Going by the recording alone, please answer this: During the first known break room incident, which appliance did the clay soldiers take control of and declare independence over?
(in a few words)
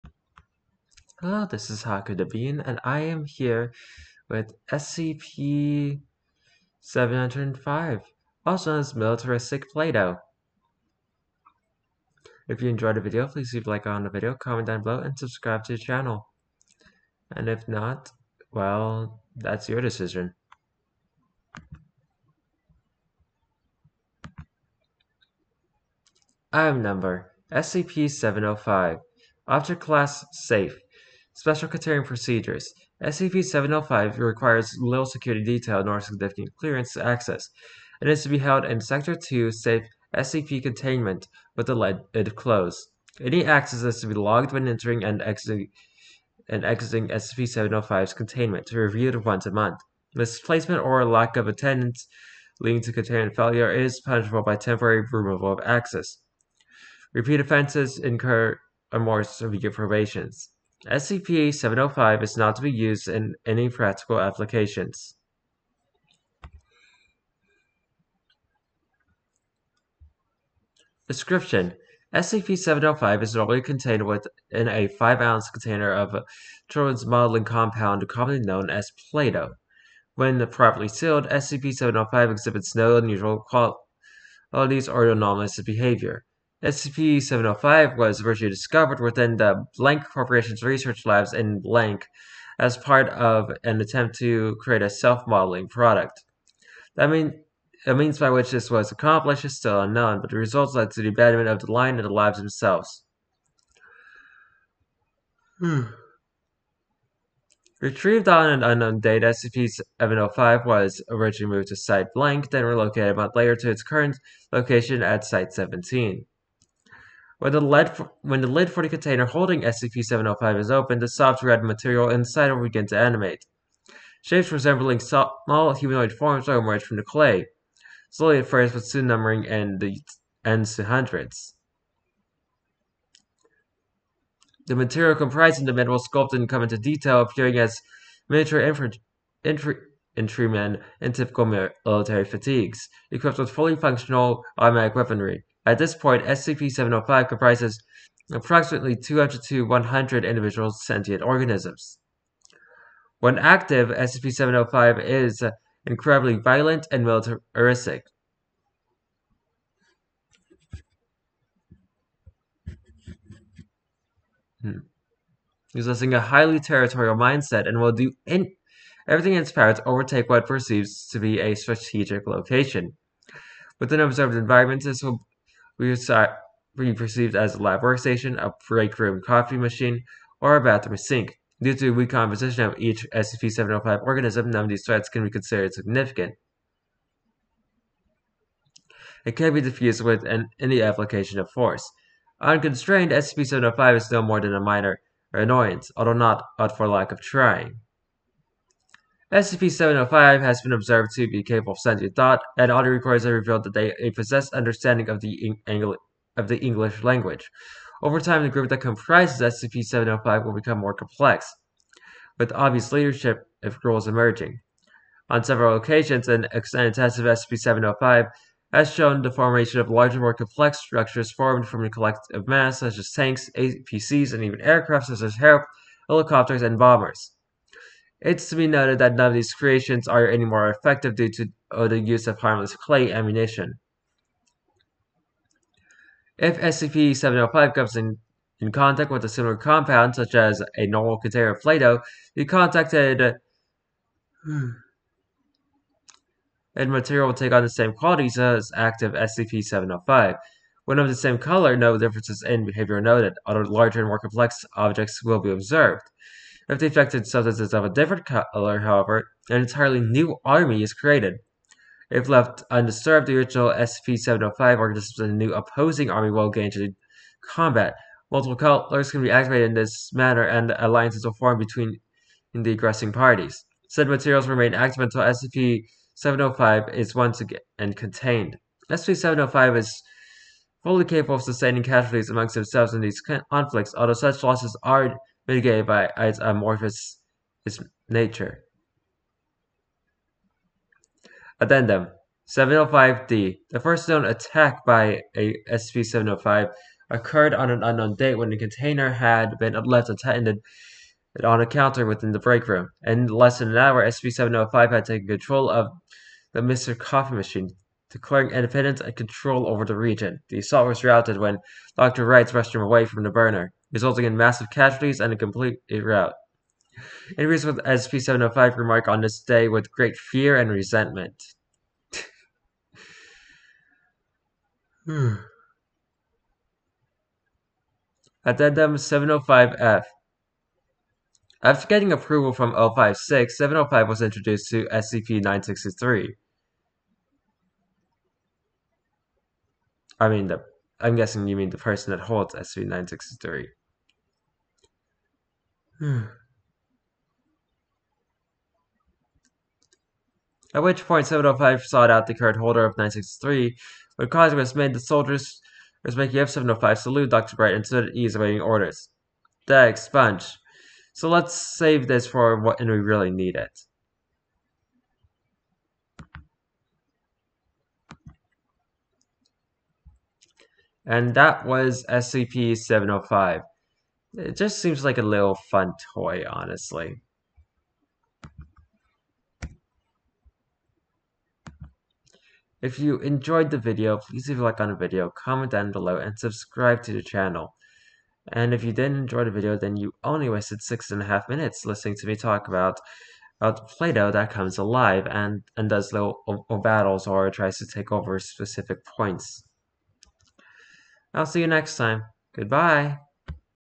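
Mr. Coffee Machine.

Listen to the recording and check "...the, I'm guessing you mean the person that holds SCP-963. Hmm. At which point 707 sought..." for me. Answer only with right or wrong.
wrong.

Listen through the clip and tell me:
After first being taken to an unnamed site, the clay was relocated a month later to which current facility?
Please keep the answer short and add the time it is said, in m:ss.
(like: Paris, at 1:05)
Site 17, at 1:55.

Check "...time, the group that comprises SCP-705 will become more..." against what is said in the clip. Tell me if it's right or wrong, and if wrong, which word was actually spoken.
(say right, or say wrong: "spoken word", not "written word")
right.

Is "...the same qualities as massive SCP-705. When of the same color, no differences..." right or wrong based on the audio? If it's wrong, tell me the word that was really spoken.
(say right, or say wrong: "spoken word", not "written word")
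wrong: "active", not "massive".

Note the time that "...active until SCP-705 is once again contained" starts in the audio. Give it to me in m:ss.
4:34.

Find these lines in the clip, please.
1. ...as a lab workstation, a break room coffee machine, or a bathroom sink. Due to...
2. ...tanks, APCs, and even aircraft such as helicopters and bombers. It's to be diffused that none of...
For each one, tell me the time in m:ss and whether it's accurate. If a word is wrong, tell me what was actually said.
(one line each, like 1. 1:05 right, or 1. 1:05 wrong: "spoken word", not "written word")
1. 2:57 right
2. 3:43 wrong: "noted", not "diffused".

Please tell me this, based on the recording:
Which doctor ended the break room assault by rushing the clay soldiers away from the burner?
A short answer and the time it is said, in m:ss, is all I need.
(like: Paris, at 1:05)
Dr. Wright, at 5:11.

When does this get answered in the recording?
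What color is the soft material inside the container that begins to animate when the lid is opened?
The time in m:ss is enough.
2:01.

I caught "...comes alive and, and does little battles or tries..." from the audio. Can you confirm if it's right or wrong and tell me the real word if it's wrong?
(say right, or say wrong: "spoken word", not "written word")
right.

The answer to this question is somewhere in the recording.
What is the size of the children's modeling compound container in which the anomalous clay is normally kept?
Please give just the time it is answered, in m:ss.
1:14.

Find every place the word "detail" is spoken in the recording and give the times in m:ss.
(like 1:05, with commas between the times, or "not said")
0:35, 2:16.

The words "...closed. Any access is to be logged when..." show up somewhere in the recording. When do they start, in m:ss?
0:42.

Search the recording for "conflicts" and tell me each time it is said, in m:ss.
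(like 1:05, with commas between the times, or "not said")
4:43.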